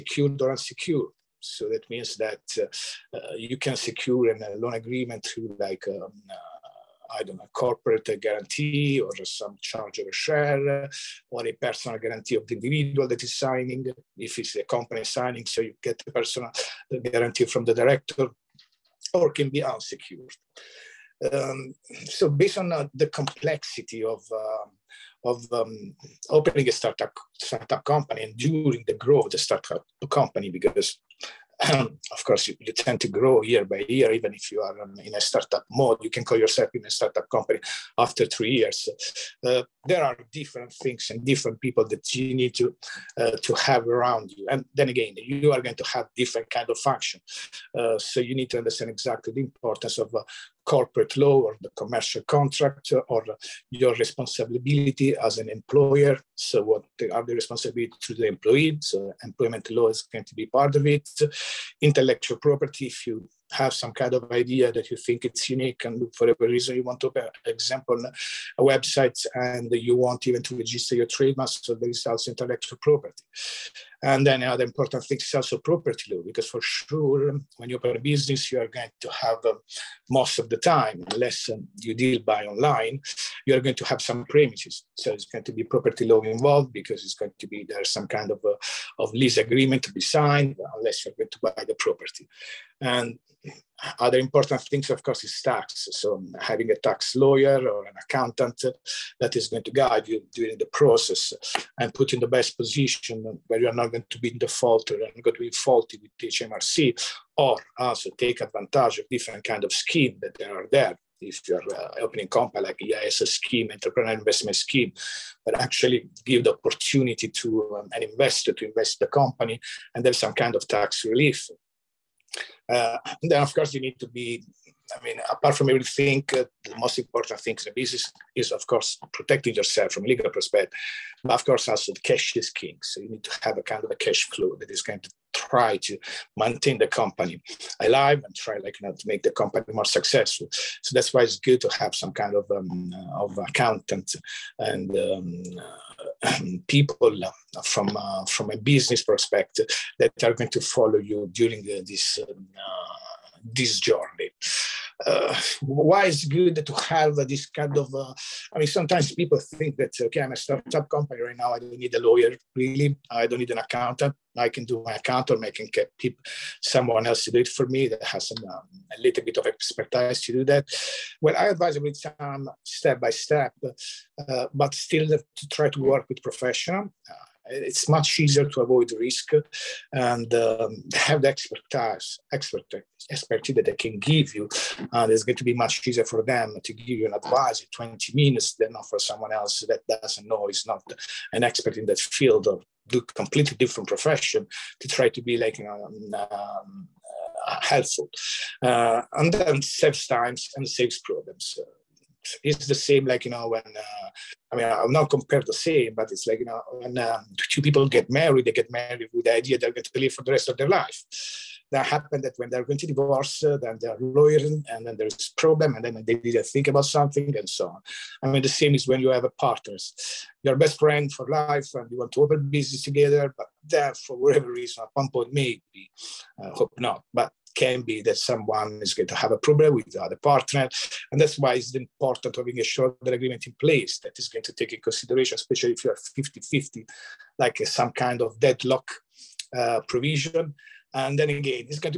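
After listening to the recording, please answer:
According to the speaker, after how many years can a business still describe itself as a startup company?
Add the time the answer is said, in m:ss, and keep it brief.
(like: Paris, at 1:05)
3 years, at 0:38.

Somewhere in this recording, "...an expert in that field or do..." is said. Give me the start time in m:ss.
3:11.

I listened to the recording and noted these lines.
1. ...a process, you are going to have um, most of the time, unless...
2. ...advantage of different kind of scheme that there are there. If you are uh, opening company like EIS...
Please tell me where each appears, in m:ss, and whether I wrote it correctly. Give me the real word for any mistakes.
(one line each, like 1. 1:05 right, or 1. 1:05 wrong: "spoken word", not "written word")
1. 1:17 wrong: "business", not "process"
2. 1:48 right.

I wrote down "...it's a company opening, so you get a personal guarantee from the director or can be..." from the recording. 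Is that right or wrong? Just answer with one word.
wrong.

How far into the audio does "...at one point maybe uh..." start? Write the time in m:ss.
3:44.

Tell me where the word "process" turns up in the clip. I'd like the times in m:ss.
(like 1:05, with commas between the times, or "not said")
1:40.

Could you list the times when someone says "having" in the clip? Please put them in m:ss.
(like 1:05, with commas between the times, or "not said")
1:36, 3:52.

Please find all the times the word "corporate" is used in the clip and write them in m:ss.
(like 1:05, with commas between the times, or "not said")
0:07, 0:50.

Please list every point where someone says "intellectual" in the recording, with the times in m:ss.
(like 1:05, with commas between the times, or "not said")
1:01, 1:12.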